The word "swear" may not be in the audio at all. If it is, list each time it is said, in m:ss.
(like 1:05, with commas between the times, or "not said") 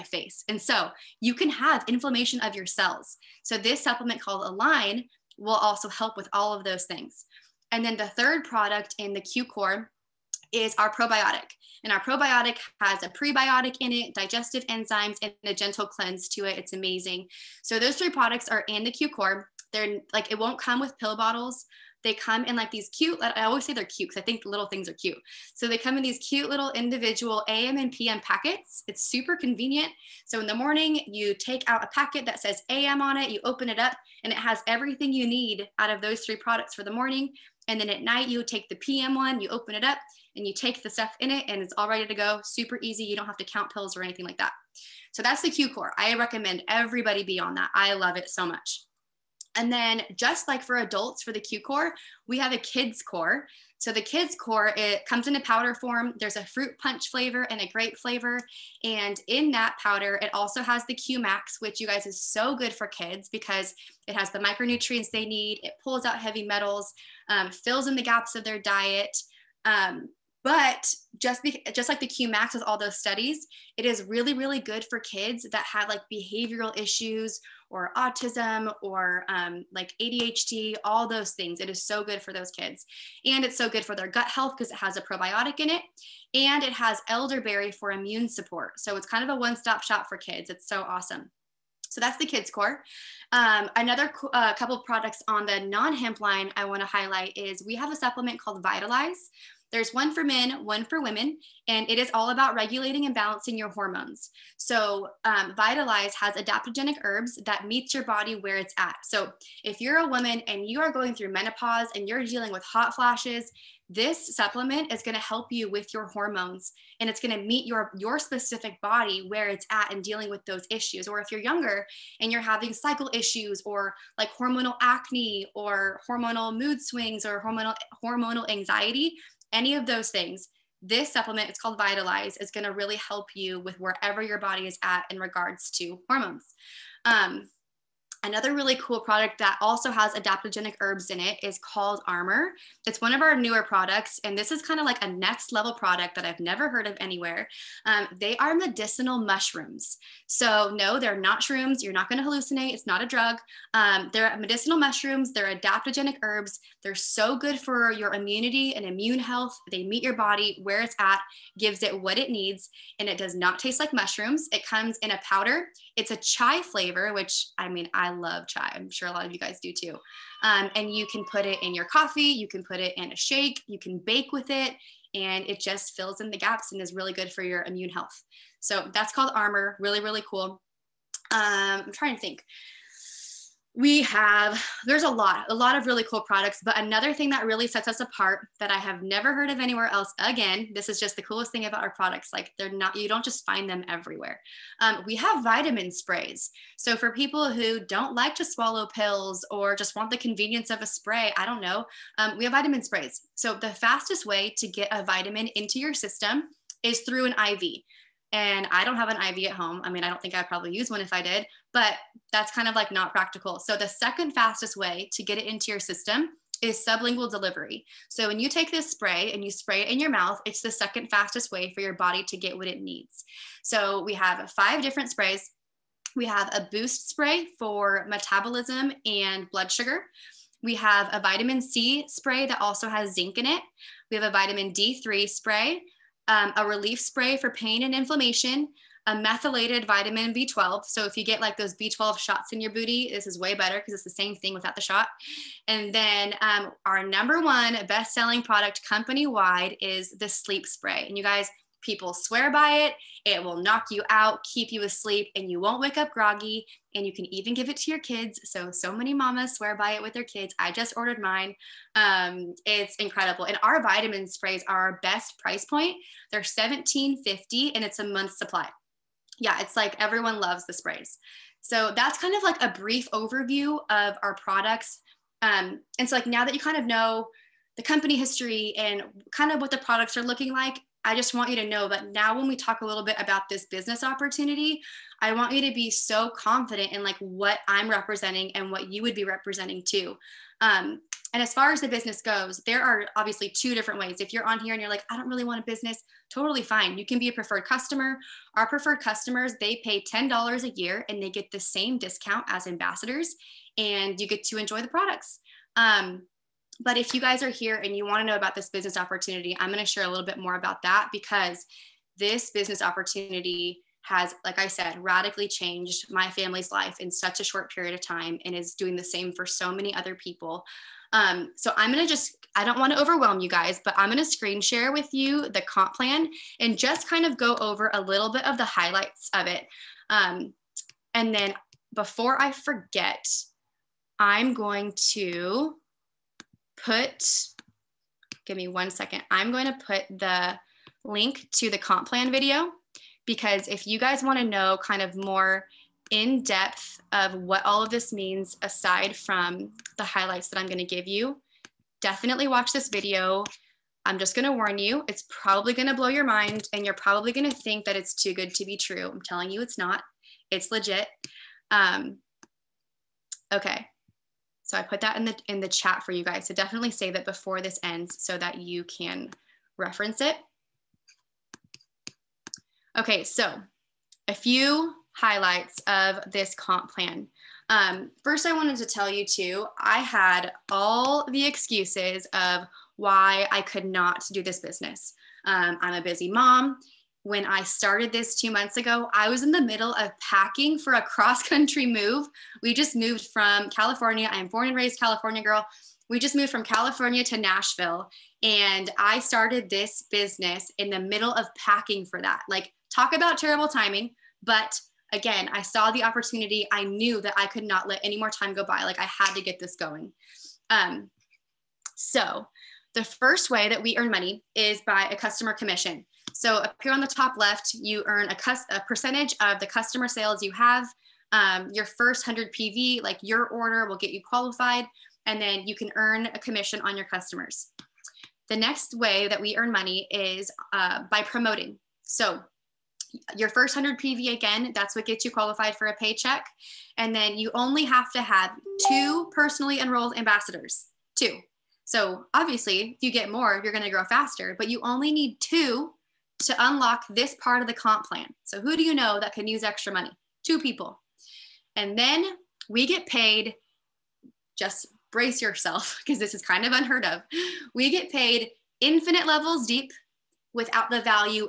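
4:12, 4:19.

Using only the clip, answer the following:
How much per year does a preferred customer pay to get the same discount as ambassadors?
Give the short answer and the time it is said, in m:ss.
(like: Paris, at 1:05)
$10, at 5:00.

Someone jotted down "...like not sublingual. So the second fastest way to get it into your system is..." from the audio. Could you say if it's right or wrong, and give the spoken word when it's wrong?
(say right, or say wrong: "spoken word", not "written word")
wrong: "practical", not "sublingual".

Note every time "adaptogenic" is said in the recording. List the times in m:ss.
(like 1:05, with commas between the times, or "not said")
1:46, 2:20, 2:35.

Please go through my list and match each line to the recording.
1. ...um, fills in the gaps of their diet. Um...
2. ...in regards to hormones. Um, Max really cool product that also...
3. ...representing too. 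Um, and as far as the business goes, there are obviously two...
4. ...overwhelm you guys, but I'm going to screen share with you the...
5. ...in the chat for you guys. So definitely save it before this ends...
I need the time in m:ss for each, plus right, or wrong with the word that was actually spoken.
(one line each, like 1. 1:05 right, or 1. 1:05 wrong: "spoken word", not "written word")
1. 1:07 right
2. 2:15 wrong: "Another", not "Max"
3. 4:49 right
4. 5:23 right
5. 6:05 right.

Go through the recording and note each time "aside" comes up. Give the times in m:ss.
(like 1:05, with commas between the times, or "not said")
5:48.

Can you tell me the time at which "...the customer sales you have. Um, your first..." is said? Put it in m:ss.
6:59.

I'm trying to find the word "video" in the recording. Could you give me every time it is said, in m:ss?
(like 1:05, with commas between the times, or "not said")
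5:42, 5:52.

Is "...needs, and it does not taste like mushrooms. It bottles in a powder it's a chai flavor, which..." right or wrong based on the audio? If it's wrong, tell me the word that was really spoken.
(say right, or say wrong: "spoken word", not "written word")
wrong: "comes", not "bottles".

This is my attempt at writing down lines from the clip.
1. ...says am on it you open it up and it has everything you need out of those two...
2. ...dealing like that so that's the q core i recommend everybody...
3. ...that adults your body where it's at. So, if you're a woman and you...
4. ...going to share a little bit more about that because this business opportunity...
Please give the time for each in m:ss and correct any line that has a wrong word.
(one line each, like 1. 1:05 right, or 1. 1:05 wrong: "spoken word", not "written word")
1. 0:32 wrong: "three", not "two"
2. 0:44 wrong: "anything", not "dealing"
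3. 1:47 wrong: "meets", not "adults"
4. 5:09 right.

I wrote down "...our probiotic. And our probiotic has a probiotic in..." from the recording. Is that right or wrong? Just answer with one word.
wrong.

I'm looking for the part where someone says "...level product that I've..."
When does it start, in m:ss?
2:25.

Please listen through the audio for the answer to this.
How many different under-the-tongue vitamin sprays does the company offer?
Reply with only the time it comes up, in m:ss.
3:44.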